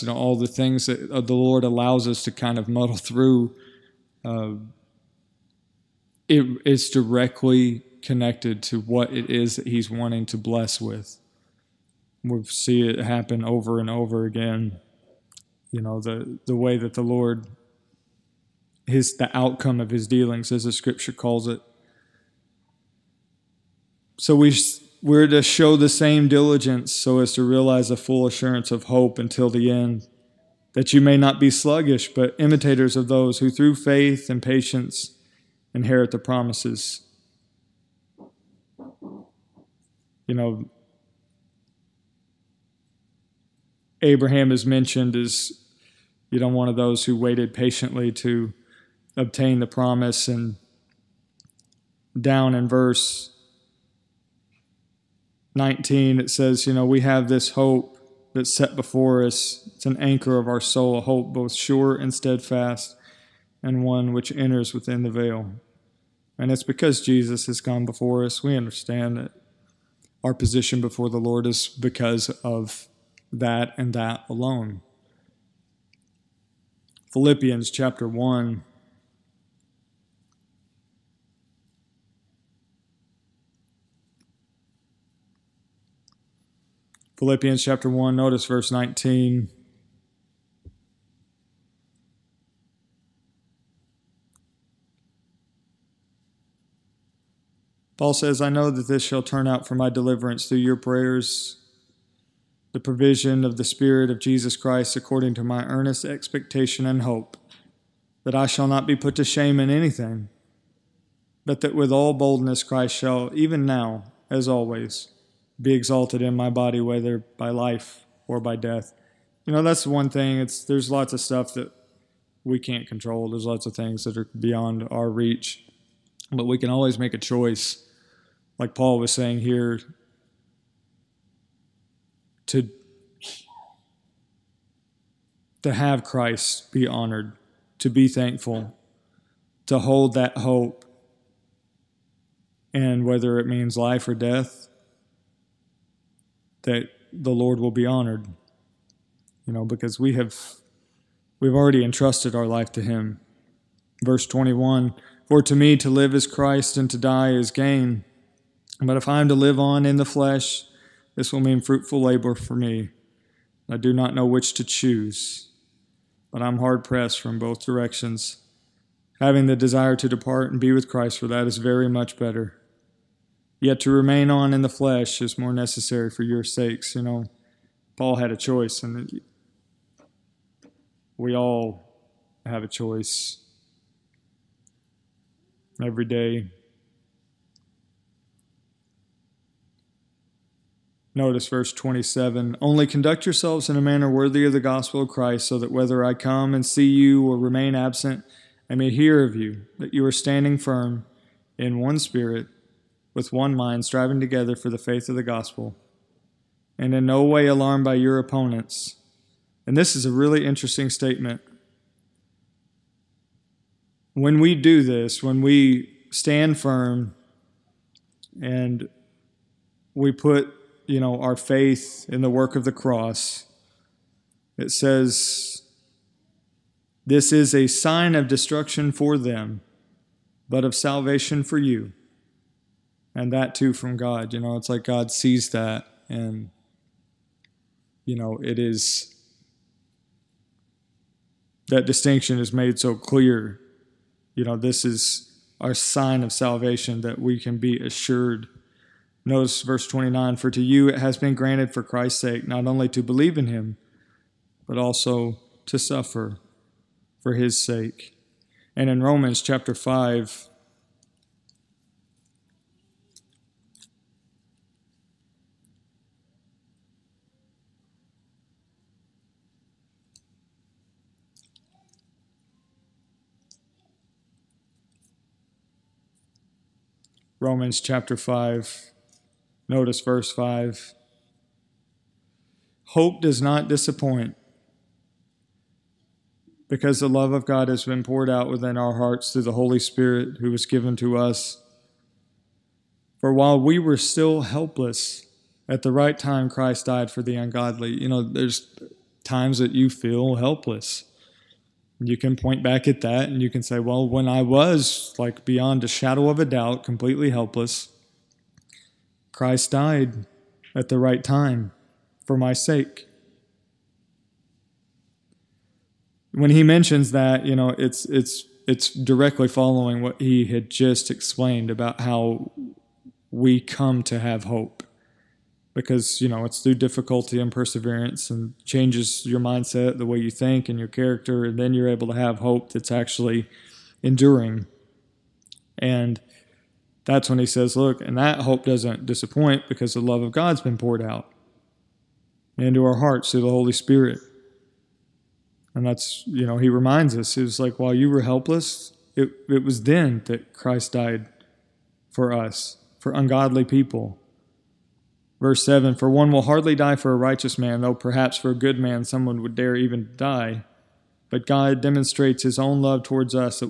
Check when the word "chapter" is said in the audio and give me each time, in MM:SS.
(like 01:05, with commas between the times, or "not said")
01:17, 01:27, 04:19, 04:37.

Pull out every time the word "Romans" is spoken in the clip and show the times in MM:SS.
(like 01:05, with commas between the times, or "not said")
04:19, 04:37.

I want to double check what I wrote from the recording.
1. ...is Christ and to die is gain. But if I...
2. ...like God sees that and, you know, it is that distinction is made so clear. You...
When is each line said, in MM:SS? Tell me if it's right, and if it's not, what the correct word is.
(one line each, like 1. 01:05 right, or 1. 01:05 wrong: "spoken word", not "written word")
1. 02:36 right
2. 03:54 right.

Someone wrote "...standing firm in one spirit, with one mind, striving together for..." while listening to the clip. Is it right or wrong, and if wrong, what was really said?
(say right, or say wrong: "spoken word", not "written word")
right.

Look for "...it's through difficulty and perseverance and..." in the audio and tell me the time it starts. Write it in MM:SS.
05:26.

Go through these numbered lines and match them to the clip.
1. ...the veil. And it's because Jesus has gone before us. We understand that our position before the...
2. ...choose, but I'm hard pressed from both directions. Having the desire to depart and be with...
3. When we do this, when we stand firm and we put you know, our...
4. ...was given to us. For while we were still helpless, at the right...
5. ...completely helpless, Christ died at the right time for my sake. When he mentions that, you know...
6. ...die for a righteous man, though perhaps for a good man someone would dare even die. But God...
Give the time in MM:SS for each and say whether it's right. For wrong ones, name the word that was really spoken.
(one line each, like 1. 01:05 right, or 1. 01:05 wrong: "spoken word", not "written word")
1. 01:05 right
2. 02:44 right
3. 03:34 right
4. 04:50 right
5. 05:06 right
6. 05:56 right.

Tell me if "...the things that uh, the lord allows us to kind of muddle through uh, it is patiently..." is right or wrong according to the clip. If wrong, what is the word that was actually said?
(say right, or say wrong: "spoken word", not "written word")
wrong: "directly", not "patiently".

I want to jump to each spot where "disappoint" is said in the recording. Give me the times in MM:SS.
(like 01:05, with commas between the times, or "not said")
04:43, 05:39.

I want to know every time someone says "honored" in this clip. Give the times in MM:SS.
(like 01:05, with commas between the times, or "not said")
02:16, 02:27.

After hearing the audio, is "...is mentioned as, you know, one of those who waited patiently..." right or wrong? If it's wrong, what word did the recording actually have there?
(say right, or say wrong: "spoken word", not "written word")
right.